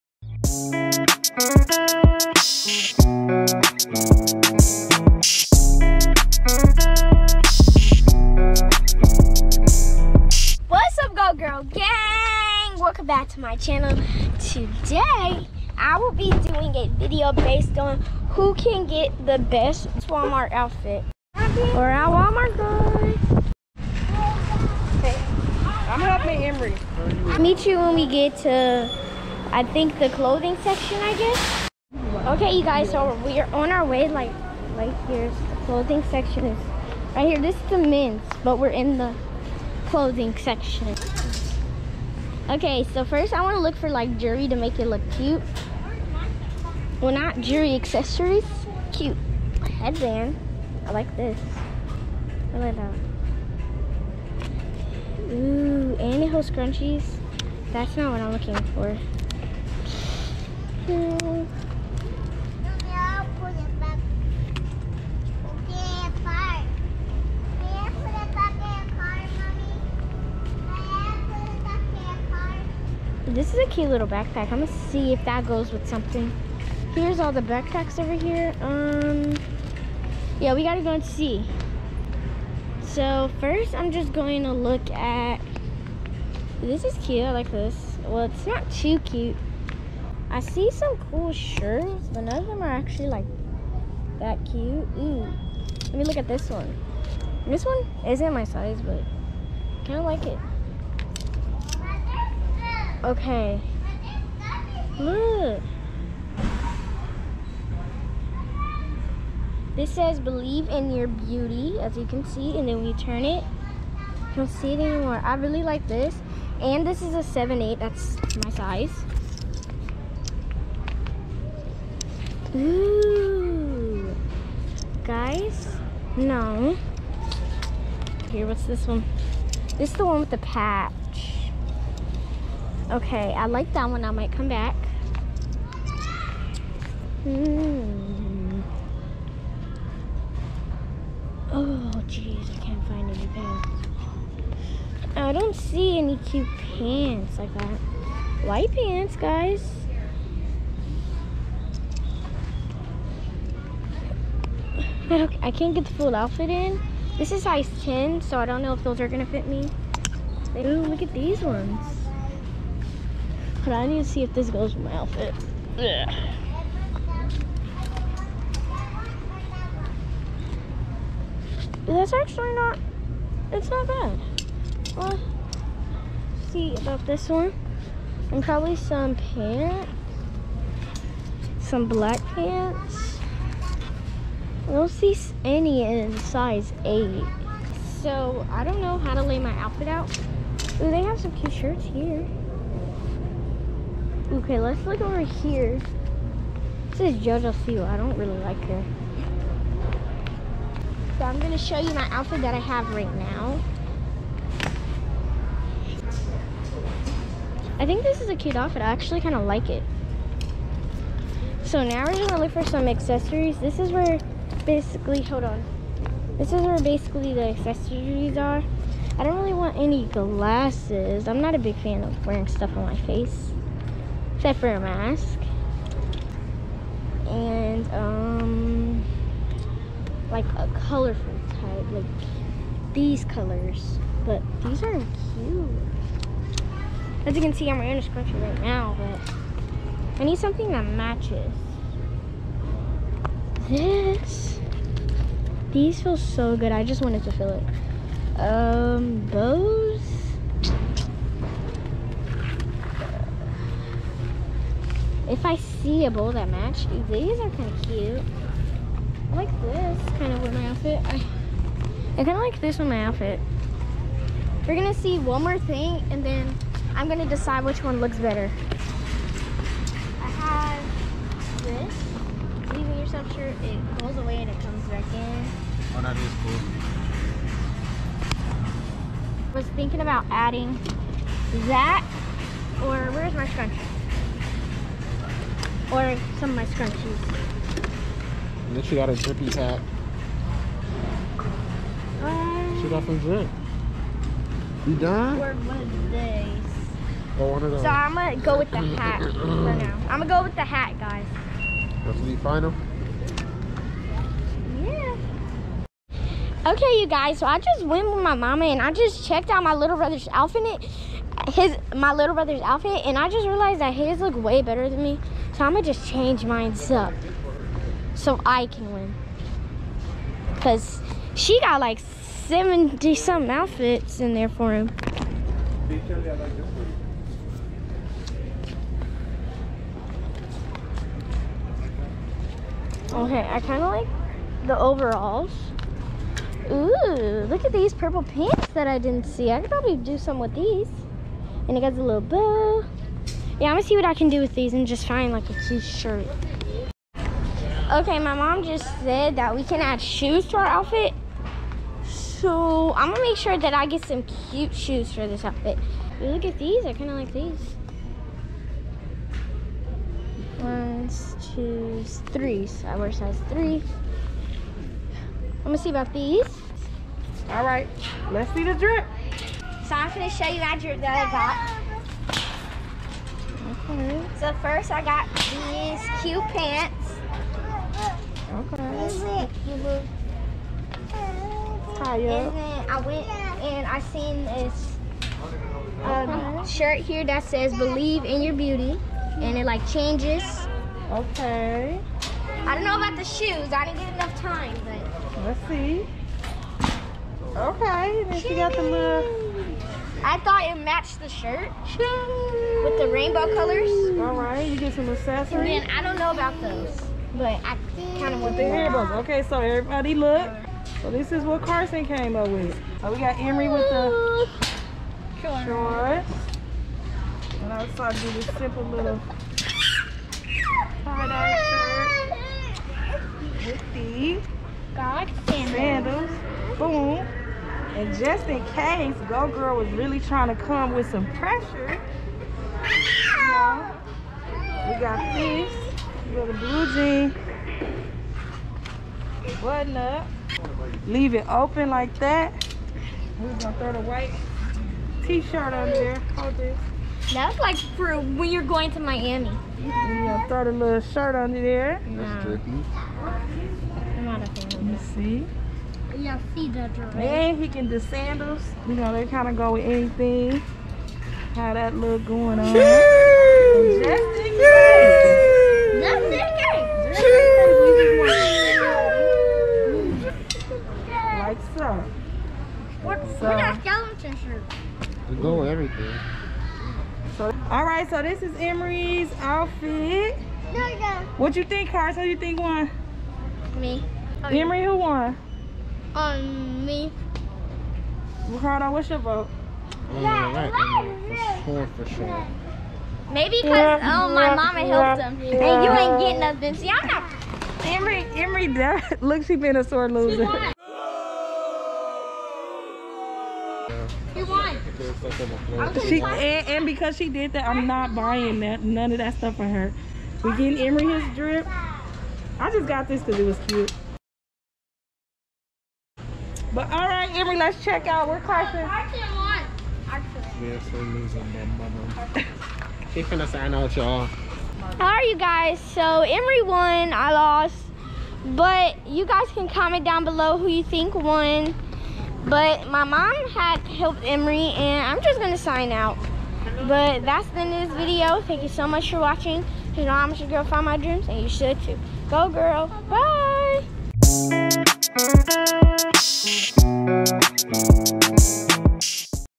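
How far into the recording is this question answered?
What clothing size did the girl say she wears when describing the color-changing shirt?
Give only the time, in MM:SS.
01:57.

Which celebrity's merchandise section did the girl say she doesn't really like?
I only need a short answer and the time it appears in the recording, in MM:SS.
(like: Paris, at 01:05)
JoJo Siwa, at 03:17.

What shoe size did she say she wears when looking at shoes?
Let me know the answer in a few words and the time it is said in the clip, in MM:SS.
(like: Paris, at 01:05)
3, at 06:03.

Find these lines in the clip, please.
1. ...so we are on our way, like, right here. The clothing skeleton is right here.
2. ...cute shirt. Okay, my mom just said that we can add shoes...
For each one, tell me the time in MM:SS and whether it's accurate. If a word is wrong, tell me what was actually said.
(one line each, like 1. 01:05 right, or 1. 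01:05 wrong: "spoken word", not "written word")
1. 00:32 wrong: "section", not "skeleton"
2. 05:45 right.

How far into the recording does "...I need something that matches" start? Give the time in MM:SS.
04:00.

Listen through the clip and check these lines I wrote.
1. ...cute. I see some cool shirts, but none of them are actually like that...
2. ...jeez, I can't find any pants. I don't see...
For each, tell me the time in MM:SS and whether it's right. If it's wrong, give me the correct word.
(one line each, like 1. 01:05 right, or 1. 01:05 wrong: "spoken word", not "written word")
1. 01:28 right
2. 02:22 right.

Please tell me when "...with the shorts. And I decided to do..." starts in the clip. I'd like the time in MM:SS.
06:53.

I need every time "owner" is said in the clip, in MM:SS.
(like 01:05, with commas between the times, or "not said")
not said.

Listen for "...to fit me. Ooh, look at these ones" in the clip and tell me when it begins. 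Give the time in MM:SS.
02:39.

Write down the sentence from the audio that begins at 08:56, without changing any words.
But that's the end of this video.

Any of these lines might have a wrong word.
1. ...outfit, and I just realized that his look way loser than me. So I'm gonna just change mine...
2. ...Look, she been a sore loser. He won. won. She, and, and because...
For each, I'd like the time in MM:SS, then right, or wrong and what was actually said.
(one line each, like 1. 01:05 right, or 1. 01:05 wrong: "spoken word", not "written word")
1. 05:12 wrong: "better", not "loser"
2. 08:19 right.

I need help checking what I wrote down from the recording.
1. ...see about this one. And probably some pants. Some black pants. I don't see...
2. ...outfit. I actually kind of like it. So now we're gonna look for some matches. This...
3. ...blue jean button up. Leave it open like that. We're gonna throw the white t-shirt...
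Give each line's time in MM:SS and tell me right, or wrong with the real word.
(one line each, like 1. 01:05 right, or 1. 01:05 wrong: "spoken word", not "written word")
1. 02:56 right
2. 03:28 wrong: "accessories", not "matches"
3. 07:16 right.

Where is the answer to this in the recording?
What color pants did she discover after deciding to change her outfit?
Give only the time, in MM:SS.
05:37.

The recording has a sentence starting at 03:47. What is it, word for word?
And um, like a colorful type, like these colors.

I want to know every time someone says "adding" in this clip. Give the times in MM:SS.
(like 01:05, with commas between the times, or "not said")
04:40.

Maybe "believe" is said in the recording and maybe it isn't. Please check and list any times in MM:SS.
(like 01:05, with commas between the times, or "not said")
01:50, 06:27.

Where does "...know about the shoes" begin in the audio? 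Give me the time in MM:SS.
06:32.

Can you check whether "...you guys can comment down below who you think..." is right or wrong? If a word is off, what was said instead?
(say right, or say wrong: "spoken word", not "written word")
right.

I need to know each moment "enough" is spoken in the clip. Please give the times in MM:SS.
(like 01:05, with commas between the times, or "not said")
06:34.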